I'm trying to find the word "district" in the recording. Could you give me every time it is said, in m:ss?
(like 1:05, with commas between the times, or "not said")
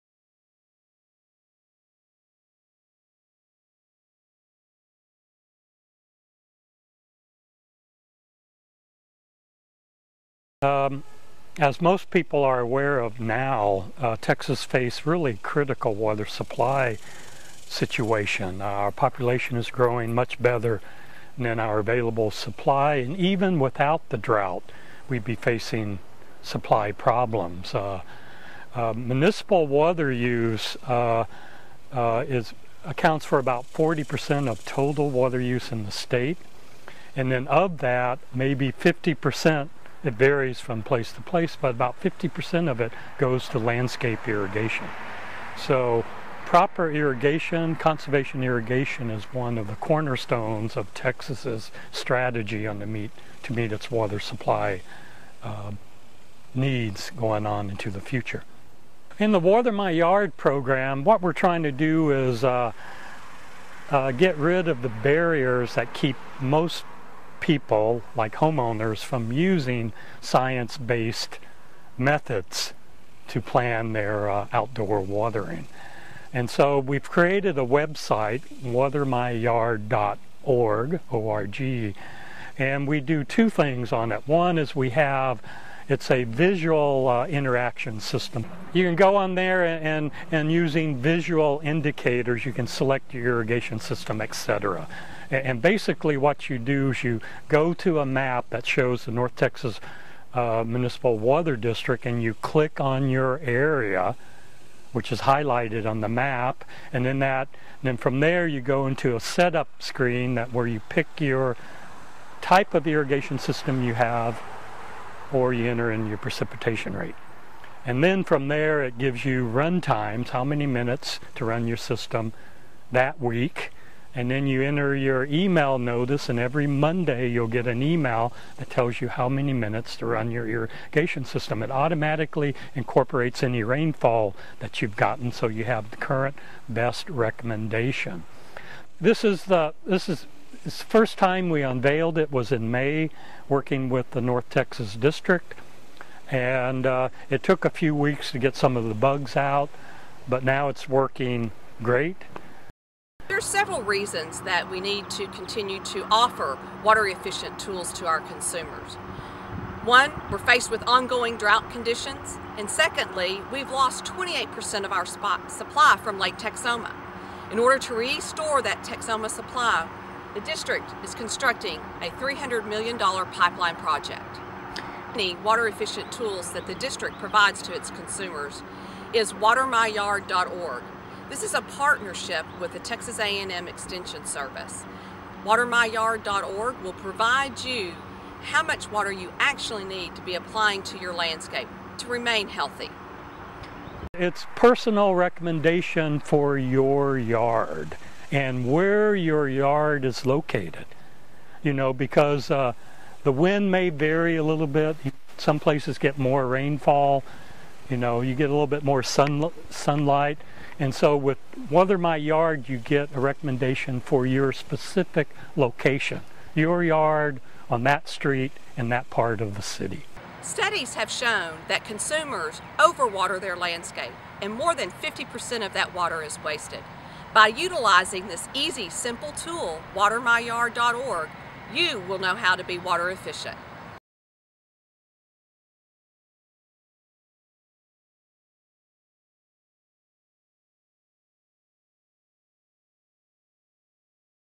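1:41, 2:24, 2:50, 2:56.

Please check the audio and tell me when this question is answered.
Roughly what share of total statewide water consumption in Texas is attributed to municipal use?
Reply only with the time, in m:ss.
0:33.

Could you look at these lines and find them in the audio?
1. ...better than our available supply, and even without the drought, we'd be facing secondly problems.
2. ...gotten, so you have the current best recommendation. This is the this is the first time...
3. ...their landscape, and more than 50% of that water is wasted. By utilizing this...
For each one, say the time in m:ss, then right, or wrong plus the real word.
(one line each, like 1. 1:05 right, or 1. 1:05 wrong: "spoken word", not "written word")
1. 0:20 wrong: "supply", not "secondly"
2. 2:14 right
3. 3:43 right.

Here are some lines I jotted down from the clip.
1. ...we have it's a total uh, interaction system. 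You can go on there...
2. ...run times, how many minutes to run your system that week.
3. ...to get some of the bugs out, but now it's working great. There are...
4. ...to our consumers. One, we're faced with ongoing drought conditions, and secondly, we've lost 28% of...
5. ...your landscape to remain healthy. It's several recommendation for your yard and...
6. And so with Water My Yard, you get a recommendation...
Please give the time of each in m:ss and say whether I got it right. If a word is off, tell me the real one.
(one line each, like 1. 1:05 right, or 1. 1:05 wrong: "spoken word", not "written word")
1. 1:24 wrong: "visual", not "total"
2. 1:59 right
3. 2:28 right
4. 2:37 right
5. 3:10 wrong: "personal", not "several"
6. 3:30 right.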